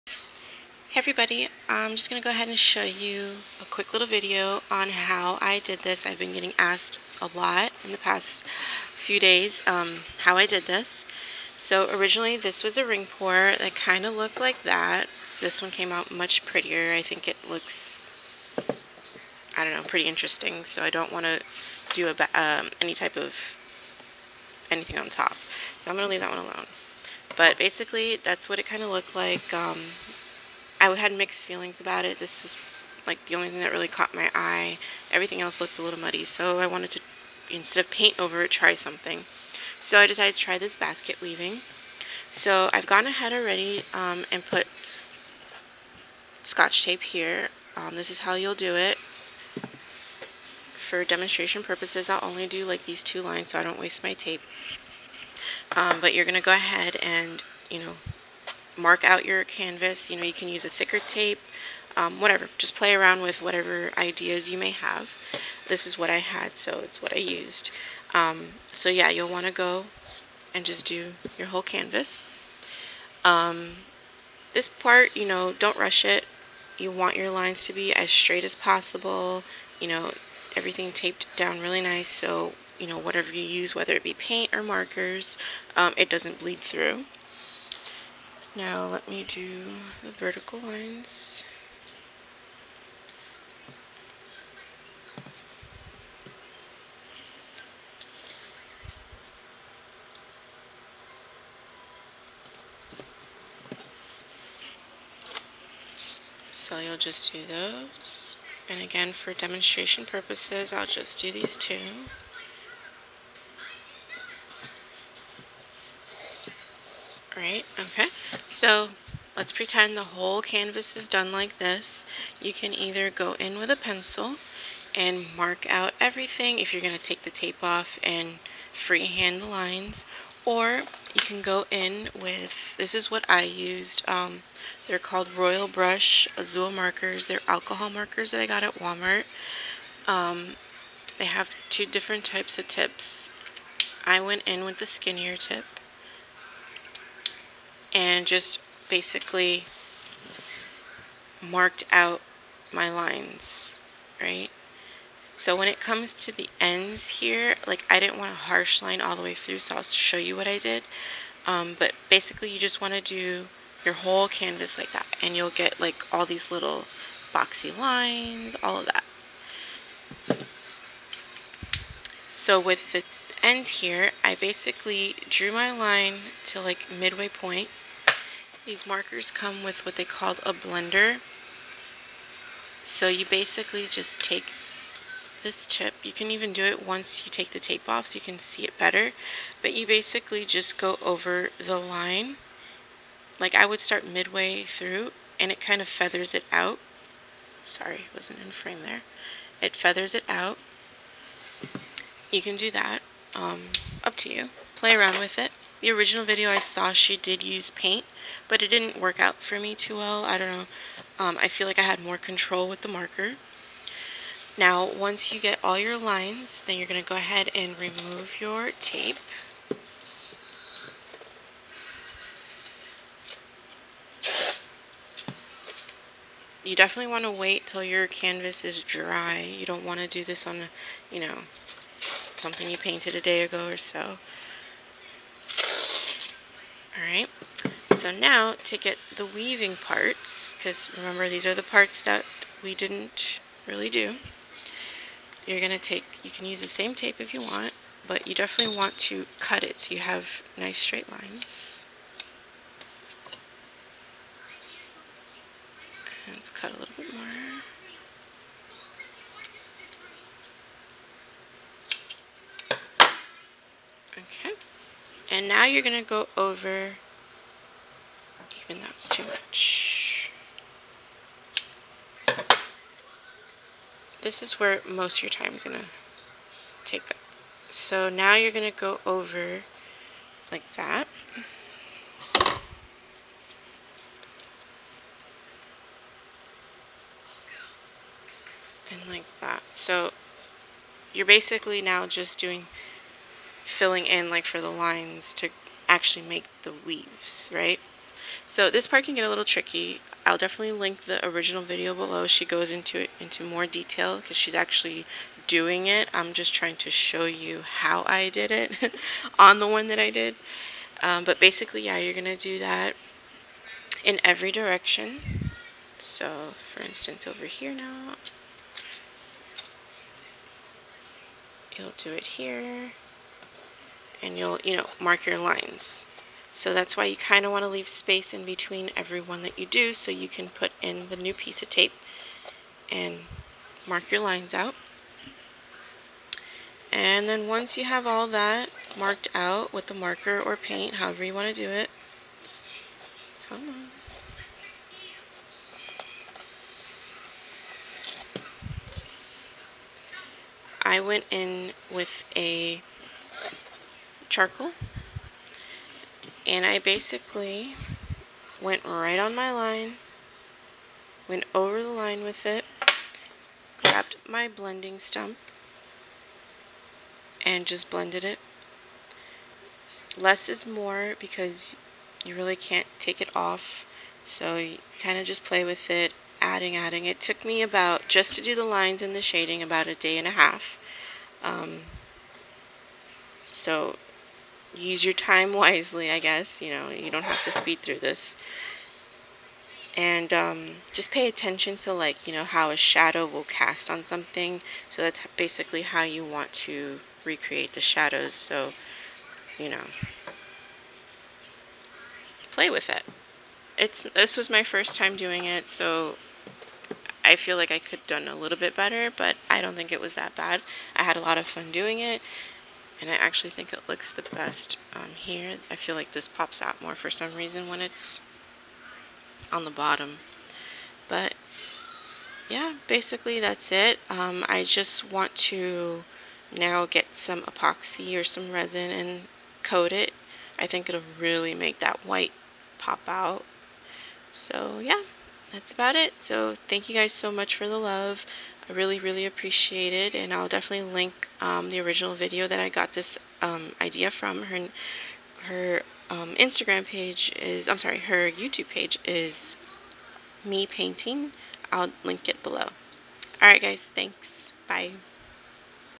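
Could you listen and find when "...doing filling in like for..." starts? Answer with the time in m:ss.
4:52.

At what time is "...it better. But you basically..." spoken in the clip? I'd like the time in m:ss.
3:08.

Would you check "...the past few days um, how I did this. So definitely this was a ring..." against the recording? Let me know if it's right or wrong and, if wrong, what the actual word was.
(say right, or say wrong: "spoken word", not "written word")
wrong: "originally", not "definitely".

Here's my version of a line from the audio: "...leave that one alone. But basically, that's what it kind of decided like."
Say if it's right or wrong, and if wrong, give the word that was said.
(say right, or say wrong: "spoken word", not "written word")
wrong: "looked", not "decided".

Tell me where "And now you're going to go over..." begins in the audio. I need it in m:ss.
4:25.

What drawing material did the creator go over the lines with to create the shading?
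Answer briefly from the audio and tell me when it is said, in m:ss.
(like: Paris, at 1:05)
charcoal, at 5:54.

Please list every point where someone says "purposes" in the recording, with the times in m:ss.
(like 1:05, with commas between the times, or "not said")
0:51, 1:50.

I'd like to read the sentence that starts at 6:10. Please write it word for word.
Less is more because you really can't take it off, so you kind of just play with it, adding, adding.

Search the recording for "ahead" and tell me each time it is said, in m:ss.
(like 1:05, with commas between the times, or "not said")
0:02, 0:43, 0:56, 3:37.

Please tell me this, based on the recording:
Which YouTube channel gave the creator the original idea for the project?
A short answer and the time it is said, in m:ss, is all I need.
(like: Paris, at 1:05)
me painting, at 7:30.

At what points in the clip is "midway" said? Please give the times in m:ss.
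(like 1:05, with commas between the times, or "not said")
2:56, 3:14.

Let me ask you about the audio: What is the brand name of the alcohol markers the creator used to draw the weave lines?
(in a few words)
Royal Brush Azul.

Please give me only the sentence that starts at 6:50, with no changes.
I had a lot of fun doing it and I actually think it looks the best um, here.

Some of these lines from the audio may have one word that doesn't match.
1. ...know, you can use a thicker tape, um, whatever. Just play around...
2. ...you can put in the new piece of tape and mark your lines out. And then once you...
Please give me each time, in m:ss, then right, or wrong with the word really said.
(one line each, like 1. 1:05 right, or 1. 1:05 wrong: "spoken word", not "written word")
1. 1:00 right
2. 5:30 right.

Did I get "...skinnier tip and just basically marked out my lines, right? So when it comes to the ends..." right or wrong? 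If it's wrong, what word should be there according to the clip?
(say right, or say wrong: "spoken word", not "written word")
right.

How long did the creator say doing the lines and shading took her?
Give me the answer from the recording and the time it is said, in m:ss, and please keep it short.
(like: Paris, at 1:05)
a day and a half, at 6:19.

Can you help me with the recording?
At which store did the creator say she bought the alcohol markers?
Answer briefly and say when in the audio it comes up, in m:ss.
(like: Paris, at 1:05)
Walmart, at 2:18.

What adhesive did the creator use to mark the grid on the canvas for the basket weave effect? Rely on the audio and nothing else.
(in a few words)
Scotch tape.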